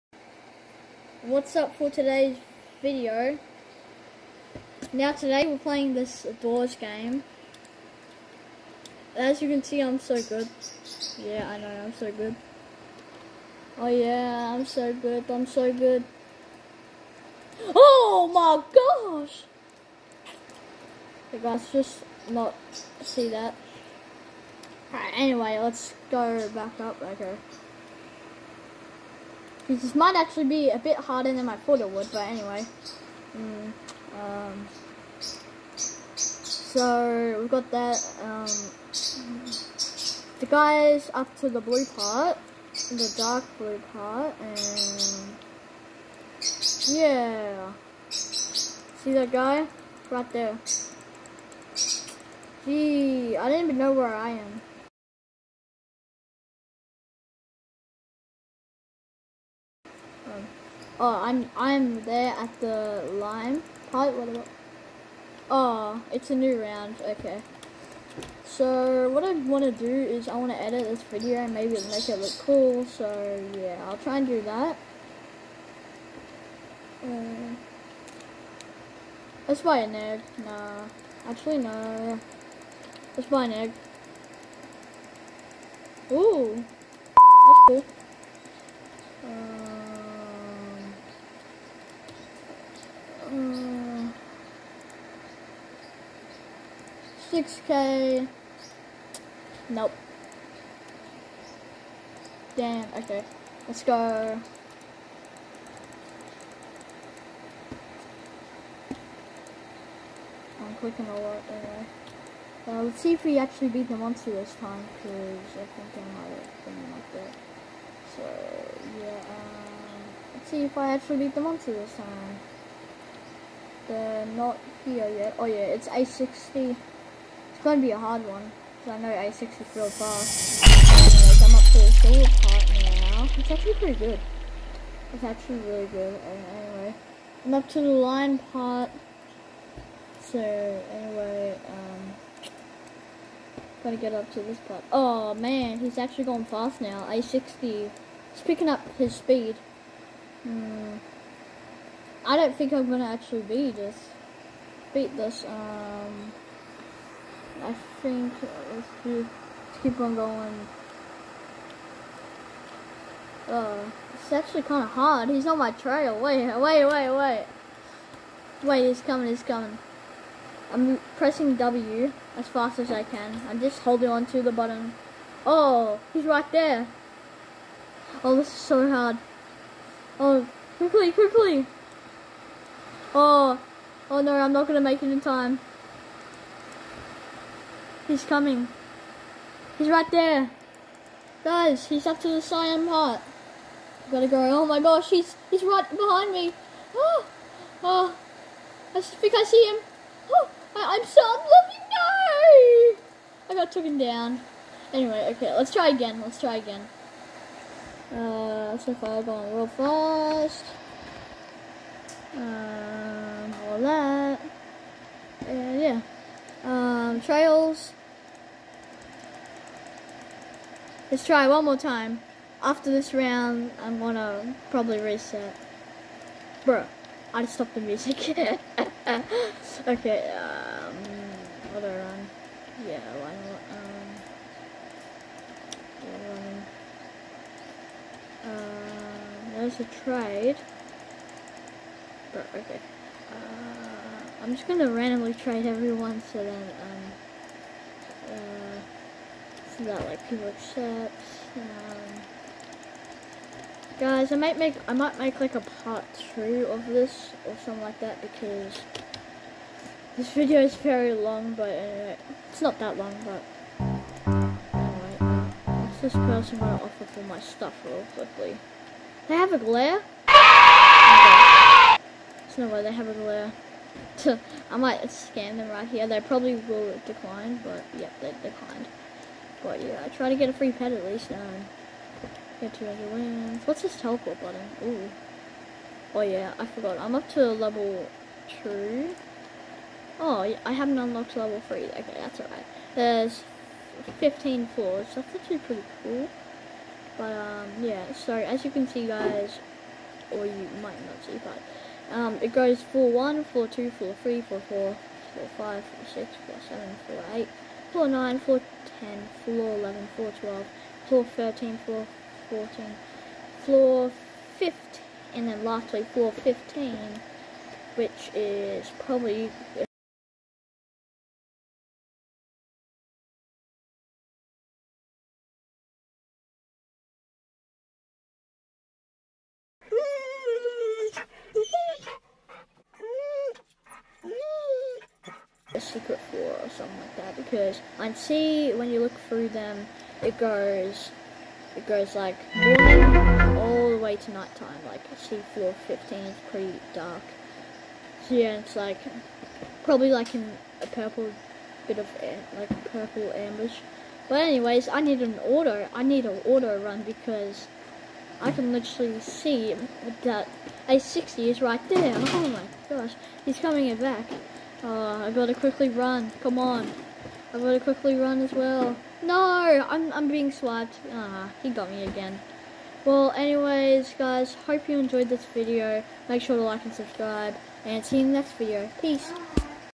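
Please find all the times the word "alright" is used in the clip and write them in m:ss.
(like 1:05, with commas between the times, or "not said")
0:24, 4:52.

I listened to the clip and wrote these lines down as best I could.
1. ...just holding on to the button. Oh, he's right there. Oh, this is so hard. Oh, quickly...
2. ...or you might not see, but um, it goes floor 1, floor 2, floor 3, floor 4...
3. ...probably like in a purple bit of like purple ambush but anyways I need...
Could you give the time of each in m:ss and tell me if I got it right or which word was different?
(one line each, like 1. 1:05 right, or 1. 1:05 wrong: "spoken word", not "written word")
1. 2:53 right
2. 5:00 right
3. 5:49 right.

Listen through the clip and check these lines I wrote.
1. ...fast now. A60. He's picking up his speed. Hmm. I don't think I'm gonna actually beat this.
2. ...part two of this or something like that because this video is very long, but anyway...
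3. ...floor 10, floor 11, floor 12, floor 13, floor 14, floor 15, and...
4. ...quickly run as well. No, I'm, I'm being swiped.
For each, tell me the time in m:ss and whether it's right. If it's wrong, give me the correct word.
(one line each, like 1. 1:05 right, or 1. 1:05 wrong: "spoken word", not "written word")
1. 2:26 right
2. 4:15 right
3. 5:08 right
4. 6:07 right.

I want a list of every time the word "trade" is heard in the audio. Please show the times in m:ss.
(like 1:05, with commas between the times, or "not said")
4:00, 4:05.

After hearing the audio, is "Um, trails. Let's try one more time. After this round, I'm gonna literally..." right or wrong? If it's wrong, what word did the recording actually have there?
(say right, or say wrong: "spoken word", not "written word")
wrong: "probably", not "literally".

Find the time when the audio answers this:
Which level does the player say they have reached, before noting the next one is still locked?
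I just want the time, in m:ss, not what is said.
4:47.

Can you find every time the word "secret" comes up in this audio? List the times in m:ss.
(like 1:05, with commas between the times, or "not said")
5:35, 5:45.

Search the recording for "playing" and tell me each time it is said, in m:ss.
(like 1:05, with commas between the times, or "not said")
0:05.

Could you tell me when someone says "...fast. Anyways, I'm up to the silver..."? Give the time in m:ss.
2:09.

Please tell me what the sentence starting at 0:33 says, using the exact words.
Mm, um, so, we've got that.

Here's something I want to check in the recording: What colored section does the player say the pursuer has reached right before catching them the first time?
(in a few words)
cyan.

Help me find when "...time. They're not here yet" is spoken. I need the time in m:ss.
2:01.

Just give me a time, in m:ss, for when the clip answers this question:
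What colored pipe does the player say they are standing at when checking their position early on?
1:03.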